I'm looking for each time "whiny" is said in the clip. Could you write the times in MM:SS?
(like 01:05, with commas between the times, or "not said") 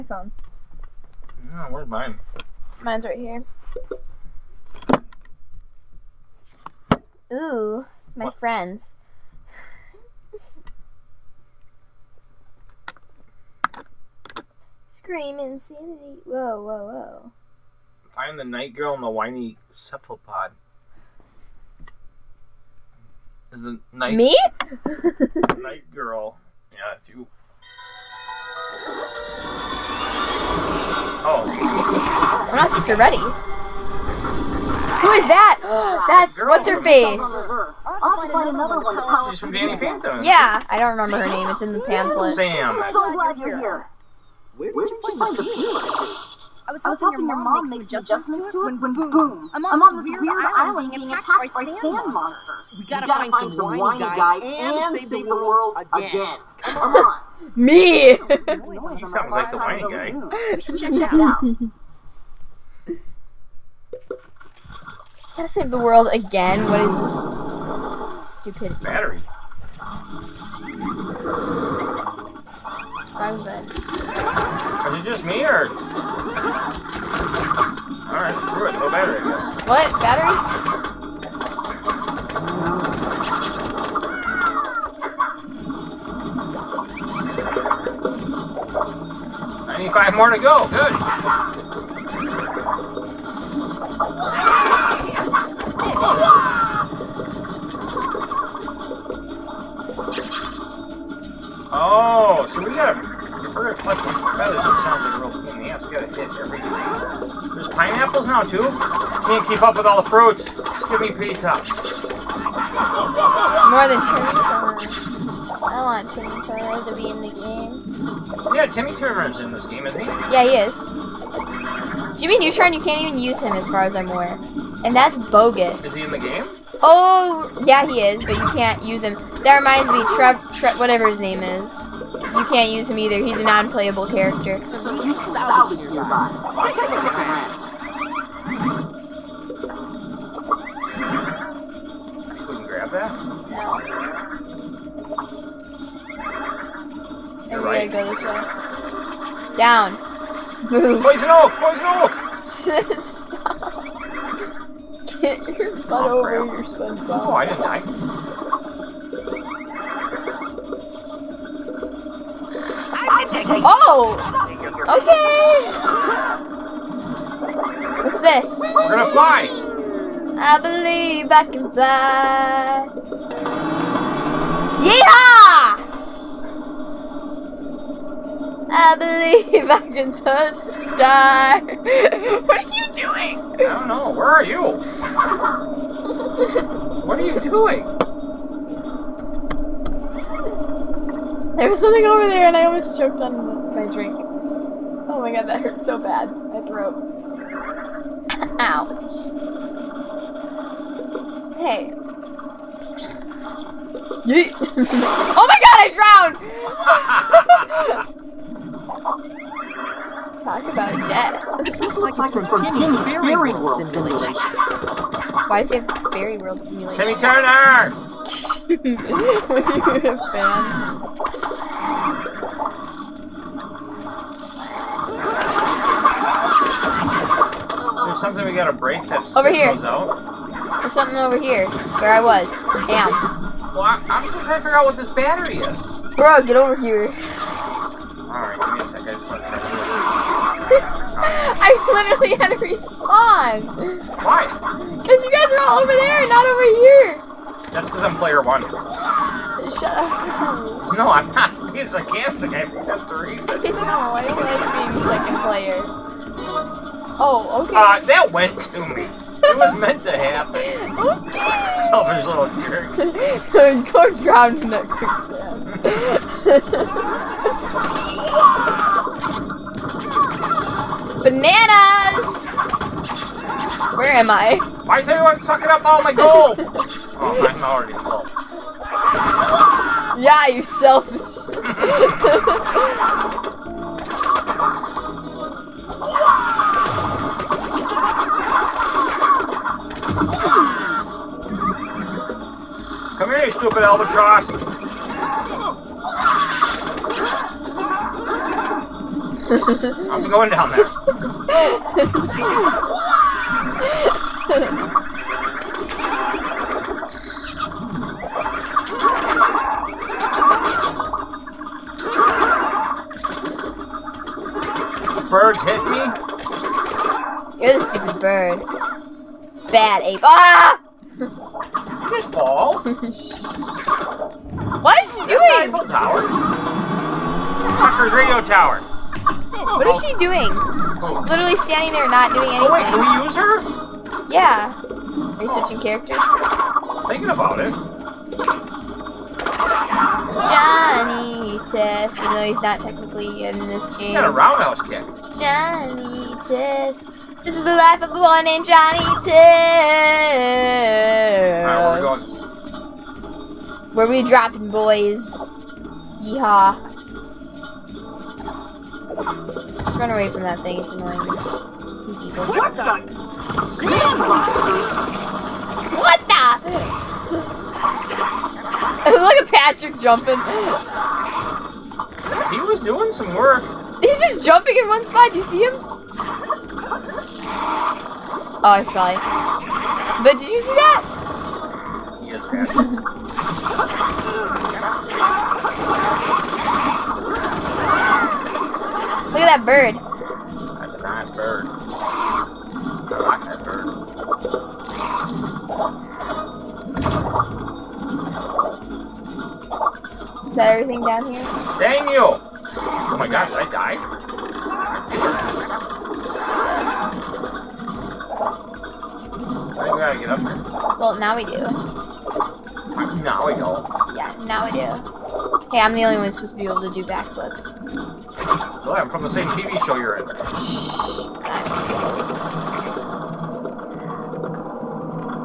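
00:19, 00:53, 00:59.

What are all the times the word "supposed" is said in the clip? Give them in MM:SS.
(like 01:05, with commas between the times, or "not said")
06:56.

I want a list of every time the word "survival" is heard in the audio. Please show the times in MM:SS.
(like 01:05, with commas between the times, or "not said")
not said.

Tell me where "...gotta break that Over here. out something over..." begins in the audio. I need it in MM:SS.
03:48.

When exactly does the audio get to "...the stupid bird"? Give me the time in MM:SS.
05:17.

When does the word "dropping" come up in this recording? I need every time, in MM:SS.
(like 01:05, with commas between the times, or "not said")
05:54.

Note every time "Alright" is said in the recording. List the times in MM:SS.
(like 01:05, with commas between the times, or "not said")
01:18, 03:58.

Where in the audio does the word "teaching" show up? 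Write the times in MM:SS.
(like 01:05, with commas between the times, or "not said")
not said.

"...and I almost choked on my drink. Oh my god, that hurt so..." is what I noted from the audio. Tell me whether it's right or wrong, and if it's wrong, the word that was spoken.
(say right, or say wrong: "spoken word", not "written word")
right.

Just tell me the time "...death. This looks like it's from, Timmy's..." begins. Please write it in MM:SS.
03:31.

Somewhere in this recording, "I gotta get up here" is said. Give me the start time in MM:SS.
06:49.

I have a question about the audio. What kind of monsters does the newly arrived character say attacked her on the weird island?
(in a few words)
sand monsters.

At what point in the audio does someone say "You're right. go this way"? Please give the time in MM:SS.
02:27.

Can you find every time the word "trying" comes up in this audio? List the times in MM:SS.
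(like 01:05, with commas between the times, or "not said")
03:54.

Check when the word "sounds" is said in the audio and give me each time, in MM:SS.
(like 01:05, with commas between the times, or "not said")
00:59.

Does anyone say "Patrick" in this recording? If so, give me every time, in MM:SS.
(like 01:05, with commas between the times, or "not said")
06:09, 06:22.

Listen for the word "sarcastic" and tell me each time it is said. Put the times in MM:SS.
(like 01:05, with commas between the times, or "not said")
04:11.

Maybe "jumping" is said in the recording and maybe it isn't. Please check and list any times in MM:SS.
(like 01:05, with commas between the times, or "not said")
06:09, 06:14.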